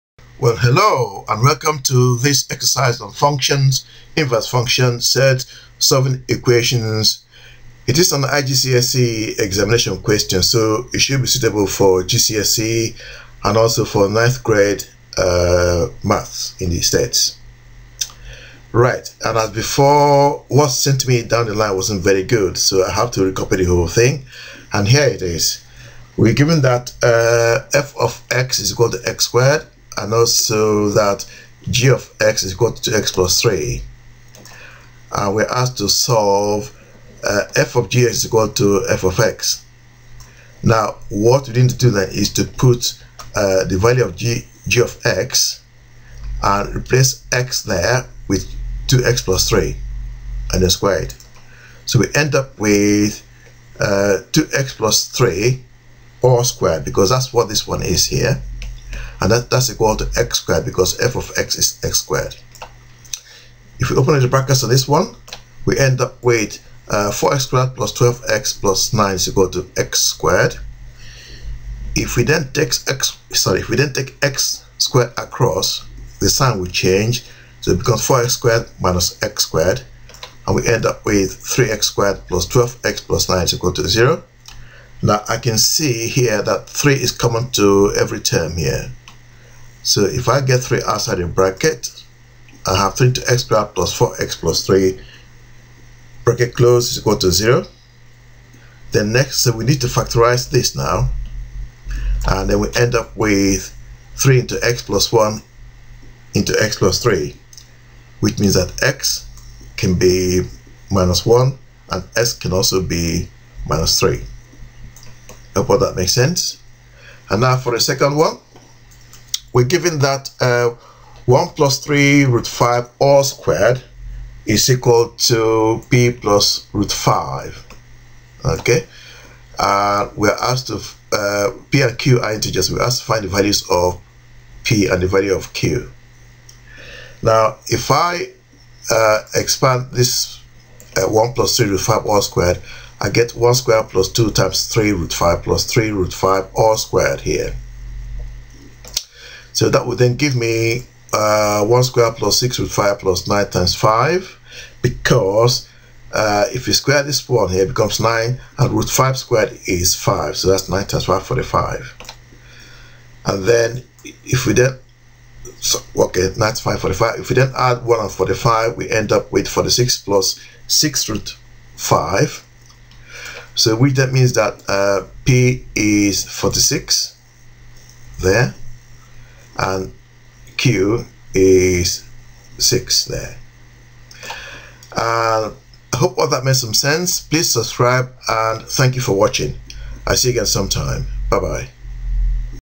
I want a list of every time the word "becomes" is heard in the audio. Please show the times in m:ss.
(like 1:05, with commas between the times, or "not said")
1:17, 2:37.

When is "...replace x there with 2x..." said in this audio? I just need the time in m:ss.
0:46.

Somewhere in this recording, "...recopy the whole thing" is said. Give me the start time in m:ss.
0:23.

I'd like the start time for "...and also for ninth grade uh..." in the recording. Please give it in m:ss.
0:13.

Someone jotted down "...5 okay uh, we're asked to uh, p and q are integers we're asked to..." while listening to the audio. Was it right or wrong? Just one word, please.
right.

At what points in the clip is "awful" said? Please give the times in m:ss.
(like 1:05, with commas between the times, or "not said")
not said.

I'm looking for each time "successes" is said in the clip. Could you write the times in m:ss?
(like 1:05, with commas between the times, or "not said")
not said.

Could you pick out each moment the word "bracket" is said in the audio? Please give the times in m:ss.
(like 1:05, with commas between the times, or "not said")
1:04, 1:31, 1:36.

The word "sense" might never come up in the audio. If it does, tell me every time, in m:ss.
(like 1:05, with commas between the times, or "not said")
1:56, 3:06.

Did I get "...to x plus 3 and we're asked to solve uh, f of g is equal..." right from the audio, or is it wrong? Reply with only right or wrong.
right.